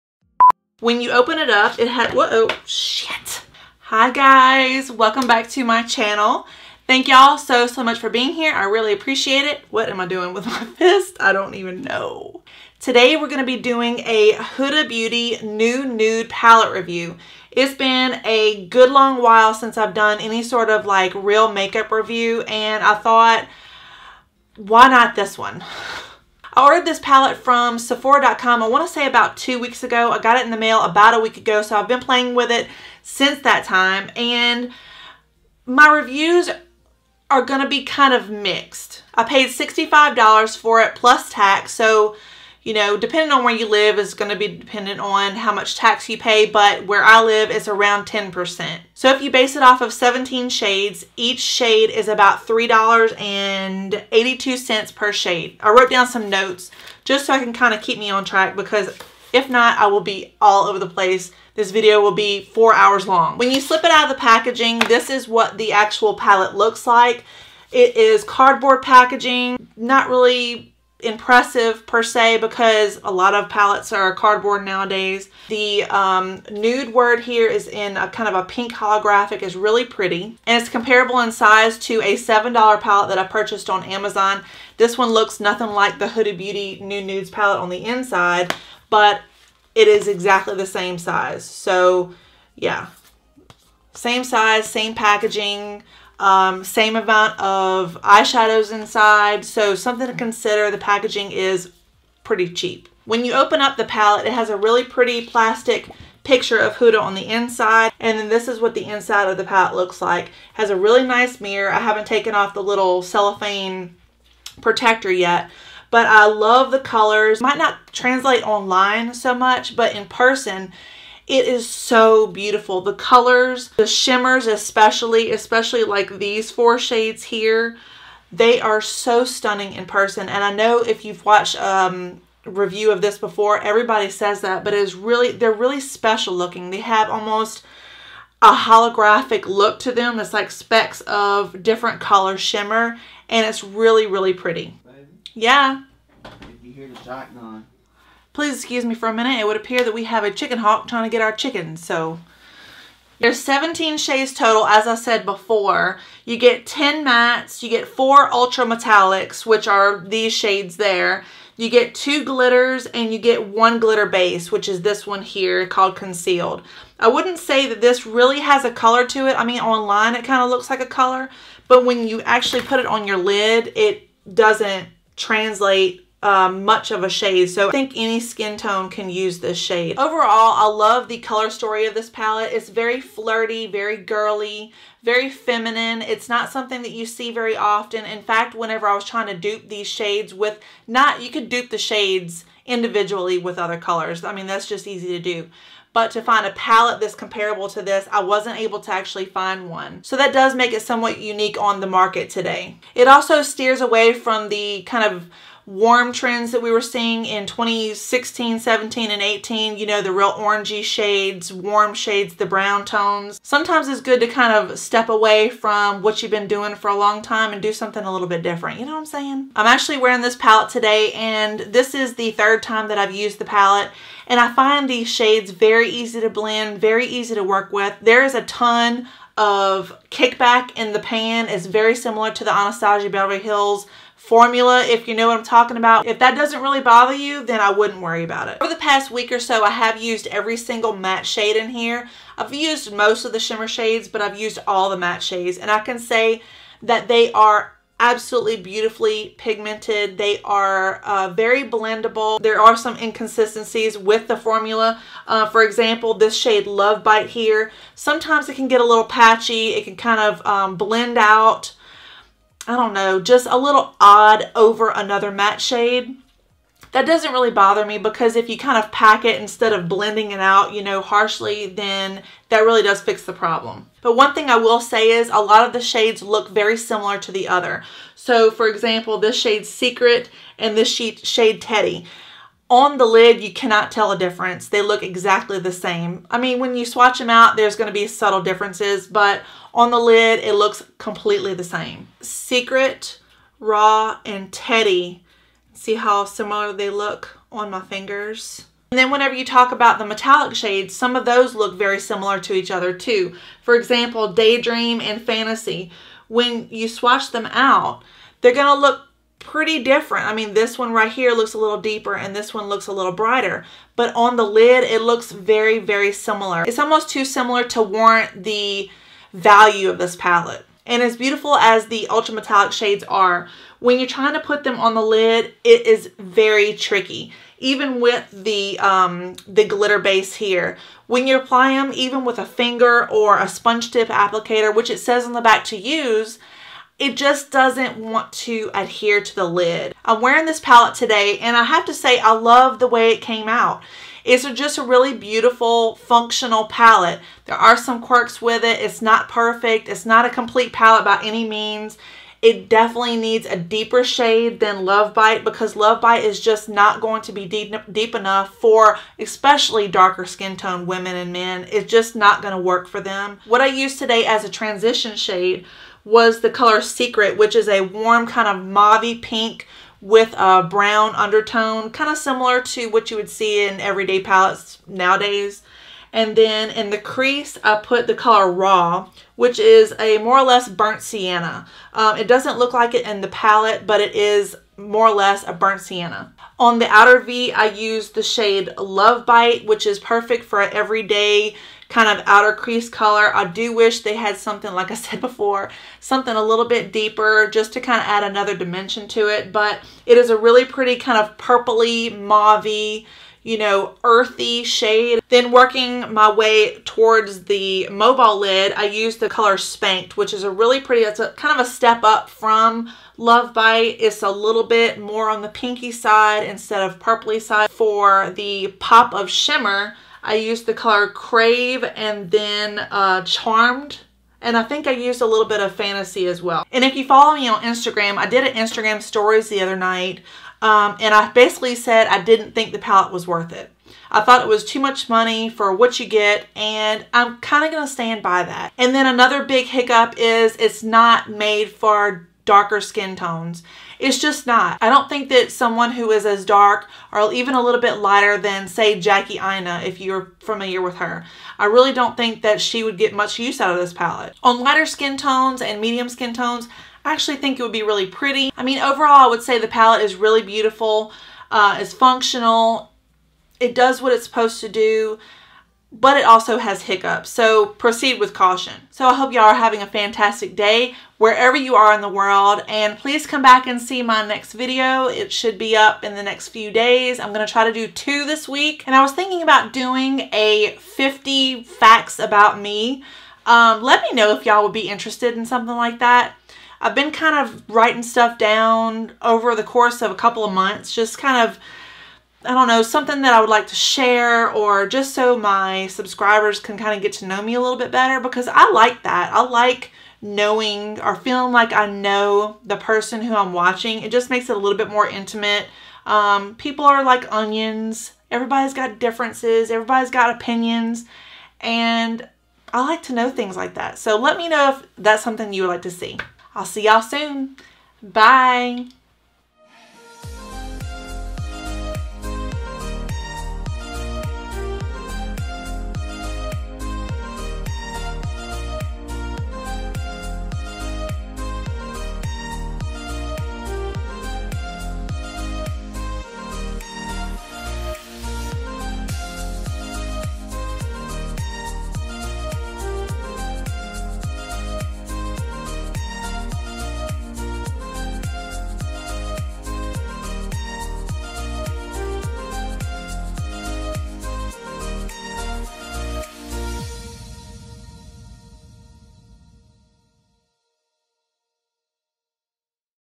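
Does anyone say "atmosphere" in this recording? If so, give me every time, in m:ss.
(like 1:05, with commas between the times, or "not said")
not said.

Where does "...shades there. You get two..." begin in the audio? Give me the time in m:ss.
2:40.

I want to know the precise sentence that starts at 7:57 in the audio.
I'm going to try to do two this week.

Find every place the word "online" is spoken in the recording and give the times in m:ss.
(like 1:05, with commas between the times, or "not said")
1:58, 2:49.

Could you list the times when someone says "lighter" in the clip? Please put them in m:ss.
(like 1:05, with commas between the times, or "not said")
7:27, 7:34.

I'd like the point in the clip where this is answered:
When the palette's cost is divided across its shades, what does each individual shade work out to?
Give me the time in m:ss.
0:52.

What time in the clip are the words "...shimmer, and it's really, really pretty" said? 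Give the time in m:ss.
2:22.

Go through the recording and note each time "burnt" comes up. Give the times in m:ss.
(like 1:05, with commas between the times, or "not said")
6:20, 6:25.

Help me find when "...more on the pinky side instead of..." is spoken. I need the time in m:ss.
6:54.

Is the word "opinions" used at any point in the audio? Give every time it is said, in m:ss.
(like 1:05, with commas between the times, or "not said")
8:30.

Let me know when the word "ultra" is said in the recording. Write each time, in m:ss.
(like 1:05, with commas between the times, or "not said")
2:38, 5:22.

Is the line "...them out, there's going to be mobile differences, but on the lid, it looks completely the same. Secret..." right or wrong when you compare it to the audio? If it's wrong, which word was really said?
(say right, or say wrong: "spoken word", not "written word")
wrong: "subtle", not "mobile".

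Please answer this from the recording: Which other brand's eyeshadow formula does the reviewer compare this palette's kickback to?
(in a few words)
Anastasia Beverly Hills.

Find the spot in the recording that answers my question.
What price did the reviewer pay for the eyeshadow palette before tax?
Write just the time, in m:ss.
0:39.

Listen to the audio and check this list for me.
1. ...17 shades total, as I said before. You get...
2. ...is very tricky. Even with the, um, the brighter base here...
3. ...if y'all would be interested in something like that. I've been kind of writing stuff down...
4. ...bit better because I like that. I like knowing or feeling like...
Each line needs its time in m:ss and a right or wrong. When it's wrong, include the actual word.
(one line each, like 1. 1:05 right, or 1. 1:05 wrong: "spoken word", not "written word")
1. 2:33 right
2. 5:25 wrong: "glitter", not "brighter"
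3. 8:04 right
4. 8:17 right.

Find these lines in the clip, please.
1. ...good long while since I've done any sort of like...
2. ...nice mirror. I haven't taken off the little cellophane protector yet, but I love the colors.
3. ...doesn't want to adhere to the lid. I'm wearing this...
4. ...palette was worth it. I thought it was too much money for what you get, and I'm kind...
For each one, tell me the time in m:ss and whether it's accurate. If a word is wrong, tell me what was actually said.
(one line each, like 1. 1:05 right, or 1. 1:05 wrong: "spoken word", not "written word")
1. 0:18 right
2. 1:51 right
3. 5:37 right
4. 7:12 right.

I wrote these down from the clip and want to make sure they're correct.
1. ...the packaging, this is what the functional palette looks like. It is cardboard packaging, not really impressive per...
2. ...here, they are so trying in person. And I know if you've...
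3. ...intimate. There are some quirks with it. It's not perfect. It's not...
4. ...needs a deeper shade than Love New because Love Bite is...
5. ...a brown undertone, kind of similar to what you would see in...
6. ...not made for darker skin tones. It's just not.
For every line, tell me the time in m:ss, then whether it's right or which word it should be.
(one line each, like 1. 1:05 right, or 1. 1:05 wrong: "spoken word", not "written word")
1. 1:04 wrong: "actual", not "functional"
2. 2:07 wrong: "stunning", not "trying"
3. 5:46 wrong: "palette", not "intimate"
4. 5:53 wrong: "Bite", not "New"
5. 6:10 right
6. 7:20 right.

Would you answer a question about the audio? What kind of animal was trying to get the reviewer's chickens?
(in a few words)
chicken hawk.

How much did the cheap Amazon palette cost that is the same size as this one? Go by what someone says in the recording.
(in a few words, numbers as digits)
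$7.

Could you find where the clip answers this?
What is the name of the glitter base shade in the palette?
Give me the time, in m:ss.
2:45.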